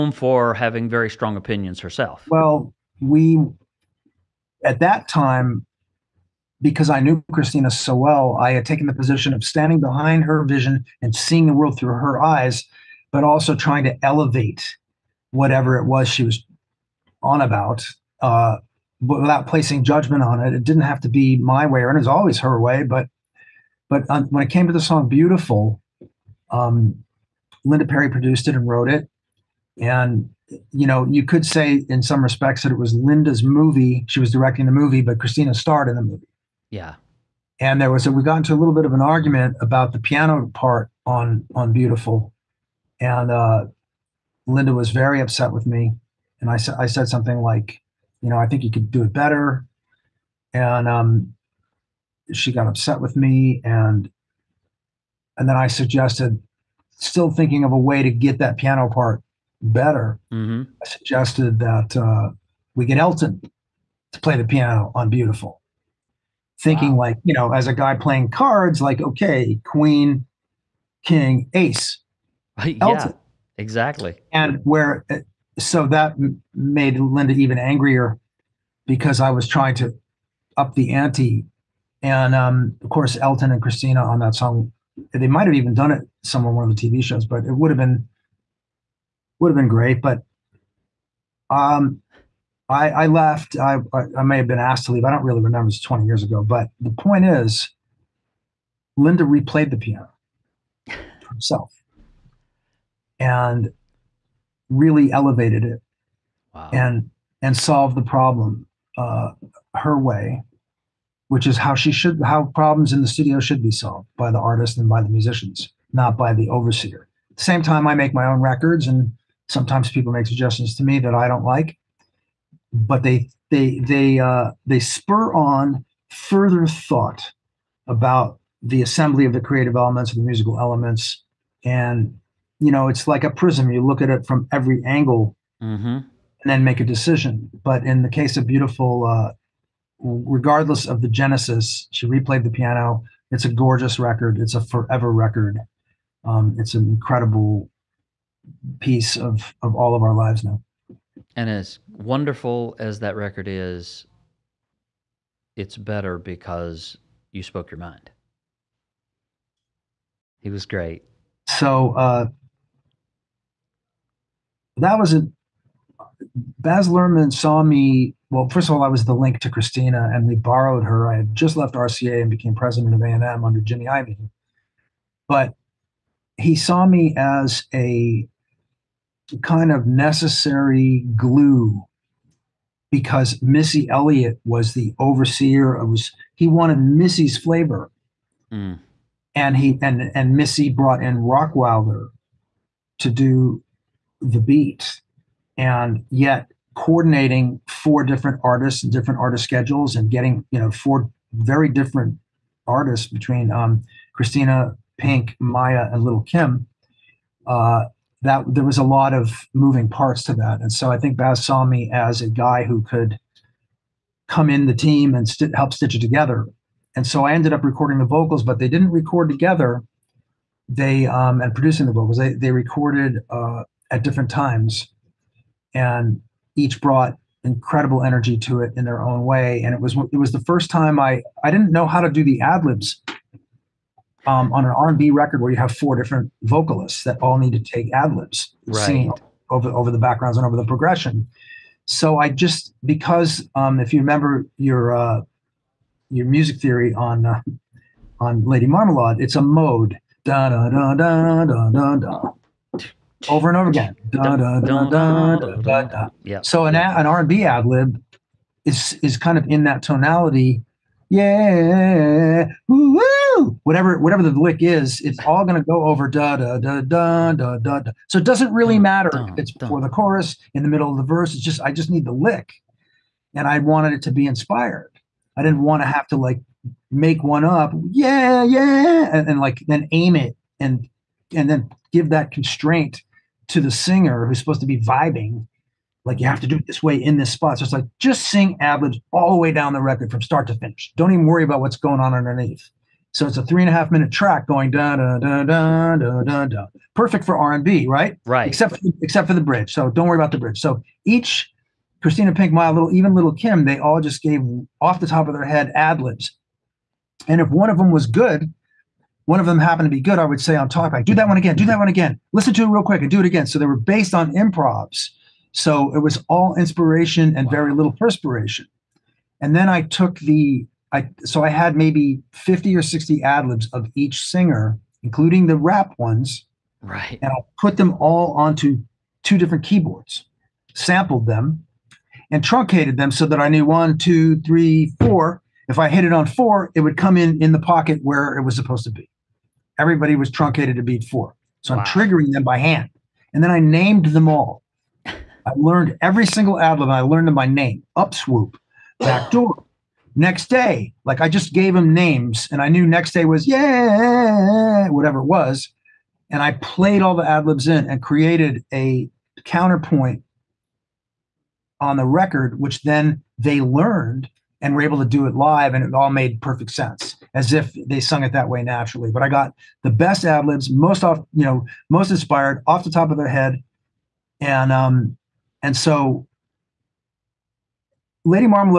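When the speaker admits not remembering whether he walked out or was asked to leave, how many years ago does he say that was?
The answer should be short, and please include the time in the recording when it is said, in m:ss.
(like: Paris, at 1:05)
20, at 1:35.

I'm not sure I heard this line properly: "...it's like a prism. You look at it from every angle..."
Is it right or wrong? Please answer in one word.
right.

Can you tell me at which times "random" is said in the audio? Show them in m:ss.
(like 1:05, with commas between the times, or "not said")
not said.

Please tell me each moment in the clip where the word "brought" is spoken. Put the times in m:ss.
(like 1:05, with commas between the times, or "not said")
3:10, 3:46.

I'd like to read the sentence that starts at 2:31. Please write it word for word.
And as wonderful as that record is, it's better because you spoke your mind.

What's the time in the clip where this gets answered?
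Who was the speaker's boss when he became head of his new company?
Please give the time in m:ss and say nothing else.
2:53.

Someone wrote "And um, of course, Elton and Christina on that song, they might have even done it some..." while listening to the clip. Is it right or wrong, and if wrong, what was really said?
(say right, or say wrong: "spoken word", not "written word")
right.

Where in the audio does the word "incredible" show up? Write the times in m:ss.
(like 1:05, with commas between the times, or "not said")
2:26, 3:47.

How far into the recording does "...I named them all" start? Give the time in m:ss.
5:43.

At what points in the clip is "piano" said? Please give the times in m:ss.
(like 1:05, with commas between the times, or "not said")
0:39, 0:58, 1:04, 1:39, 2:22.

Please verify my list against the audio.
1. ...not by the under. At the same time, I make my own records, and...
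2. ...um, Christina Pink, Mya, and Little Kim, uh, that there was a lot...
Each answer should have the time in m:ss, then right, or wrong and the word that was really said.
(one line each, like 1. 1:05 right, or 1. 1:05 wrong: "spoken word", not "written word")
1. 1:55 wrong: "overseer", not "under"
2. 3:23 right.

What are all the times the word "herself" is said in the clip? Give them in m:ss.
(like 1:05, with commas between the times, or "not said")
0:01, 1:41.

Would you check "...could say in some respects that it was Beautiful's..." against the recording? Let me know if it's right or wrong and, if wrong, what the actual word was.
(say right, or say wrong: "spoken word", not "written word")
wrong: "Linda", not "Beautiful".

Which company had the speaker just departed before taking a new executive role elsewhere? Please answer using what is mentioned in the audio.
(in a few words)
RCA.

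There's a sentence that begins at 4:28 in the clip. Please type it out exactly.
So it doesn't really matter dun, if it's before the chorus, in the middle of the verse.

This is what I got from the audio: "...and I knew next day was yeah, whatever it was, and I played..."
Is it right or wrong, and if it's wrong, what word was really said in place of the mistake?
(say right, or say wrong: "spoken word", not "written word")
right.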